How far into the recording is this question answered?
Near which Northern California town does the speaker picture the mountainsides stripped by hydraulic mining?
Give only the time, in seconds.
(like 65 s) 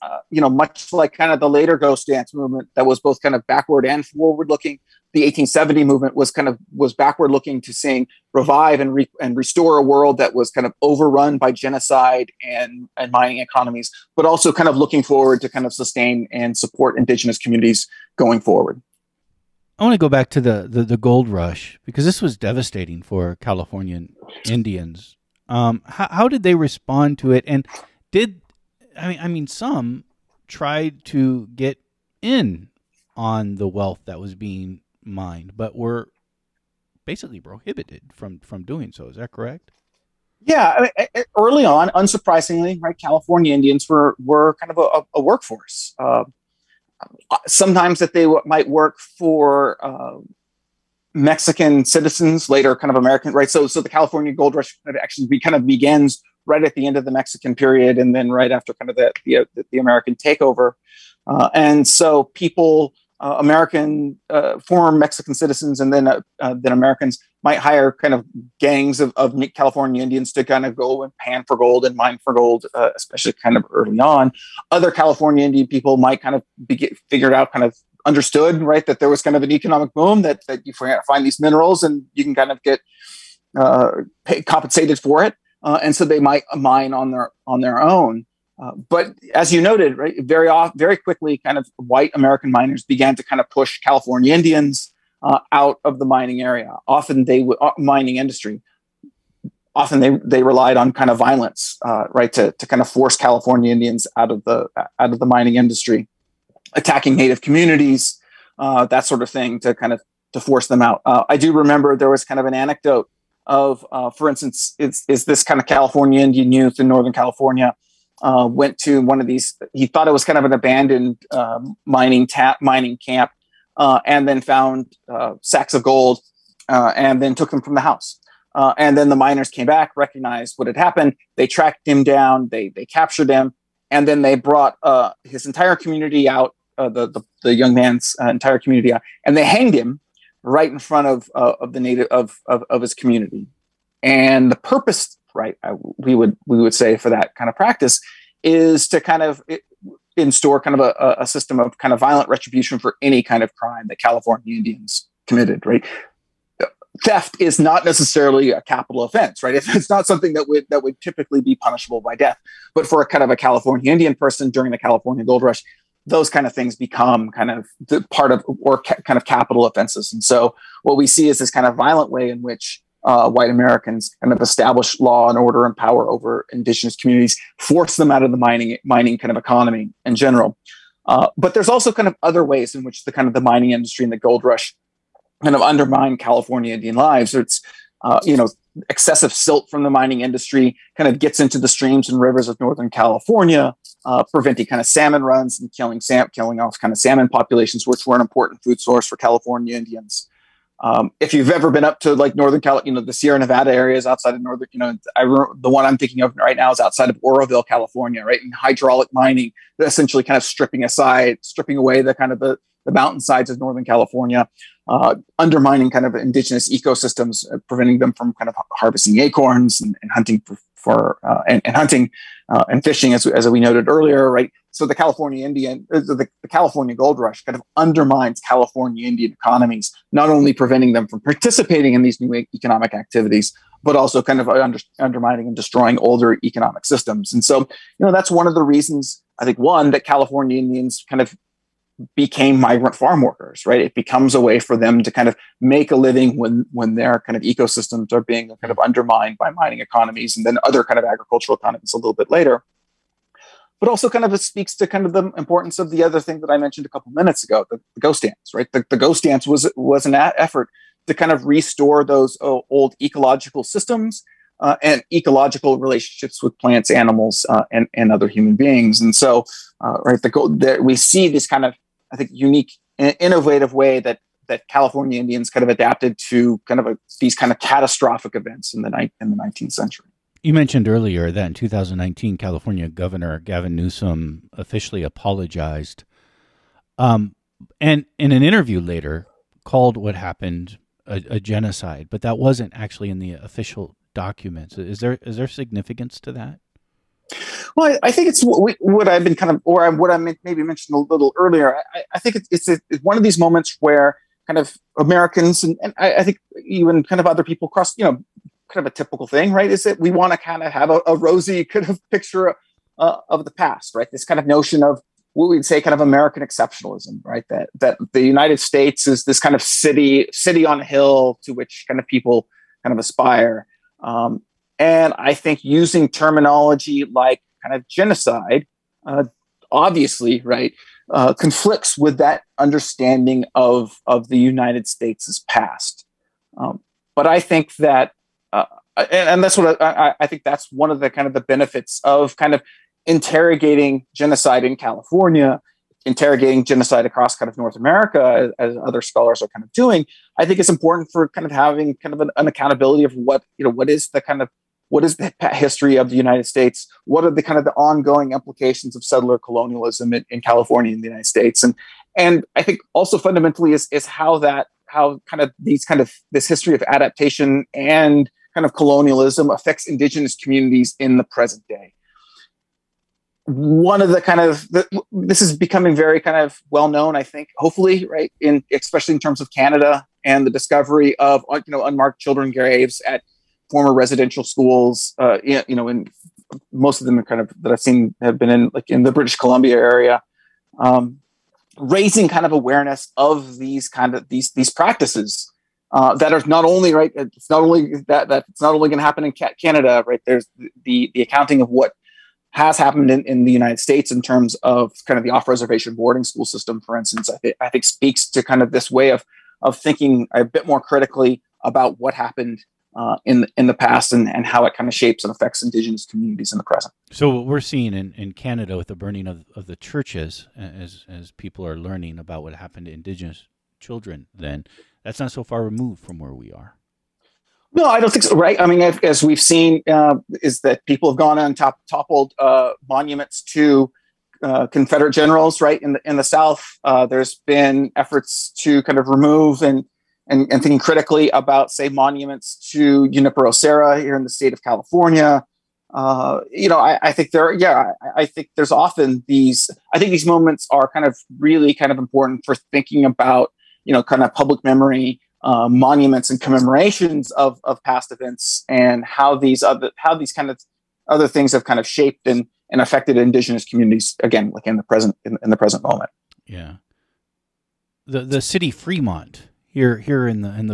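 207 s.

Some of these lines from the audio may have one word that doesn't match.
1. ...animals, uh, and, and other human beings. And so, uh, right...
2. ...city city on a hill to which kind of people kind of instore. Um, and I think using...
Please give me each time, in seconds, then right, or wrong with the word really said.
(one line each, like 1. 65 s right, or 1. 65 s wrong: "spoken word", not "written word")
1. 266 s right
2. 319 s wrong: "aspire", not "instore".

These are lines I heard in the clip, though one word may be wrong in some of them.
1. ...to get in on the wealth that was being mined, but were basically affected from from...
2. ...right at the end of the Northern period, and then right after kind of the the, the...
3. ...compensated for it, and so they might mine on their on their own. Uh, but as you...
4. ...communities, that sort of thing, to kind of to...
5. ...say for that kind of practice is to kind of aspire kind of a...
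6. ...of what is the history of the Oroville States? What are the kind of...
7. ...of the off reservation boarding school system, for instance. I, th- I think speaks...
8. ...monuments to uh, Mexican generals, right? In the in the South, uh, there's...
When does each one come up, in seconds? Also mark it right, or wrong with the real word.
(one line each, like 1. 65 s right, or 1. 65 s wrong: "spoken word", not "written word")
1. 31 s wrong: "prohibited", not "affected"
2. 56 s wrong: "Mexican", not "Northern"
3. 84 s right
4. 107 s right
5. 146 s wrong: "instore", not "aspire"
6. 354 s wrong: "United", not "Oroville"
7. 405 s right
8. 432 s wrong: "Confederate", not "Mexican".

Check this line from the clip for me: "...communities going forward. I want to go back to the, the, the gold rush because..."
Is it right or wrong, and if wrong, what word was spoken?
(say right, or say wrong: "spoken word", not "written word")
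right.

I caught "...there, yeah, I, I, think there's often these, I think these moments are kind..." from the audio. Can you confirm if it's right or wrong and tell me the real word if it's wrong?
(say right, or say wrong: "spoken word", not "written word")
right.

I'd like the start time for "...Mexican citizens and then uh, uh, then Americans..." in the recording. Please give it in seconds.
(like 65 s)
64 s.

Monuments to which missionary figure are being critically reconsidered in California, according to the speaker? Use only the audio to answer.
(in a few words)
Junipero Serra.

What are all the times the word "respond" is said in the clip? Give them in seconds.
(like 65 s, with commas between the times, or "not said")
26 s.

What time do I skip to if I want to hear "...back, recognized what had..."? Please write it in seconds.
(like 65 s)
129 s.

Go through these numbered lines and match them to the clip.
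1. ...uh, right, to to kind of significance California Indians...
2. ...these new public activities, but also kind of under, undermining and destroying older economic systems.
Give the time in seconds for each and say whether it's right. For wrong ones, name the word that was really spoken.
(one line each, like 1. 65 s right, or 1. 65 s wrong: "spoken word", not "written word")
1. 101 s wrong: "force", not "significance"
2. 232 s wrong: "economic", not "public".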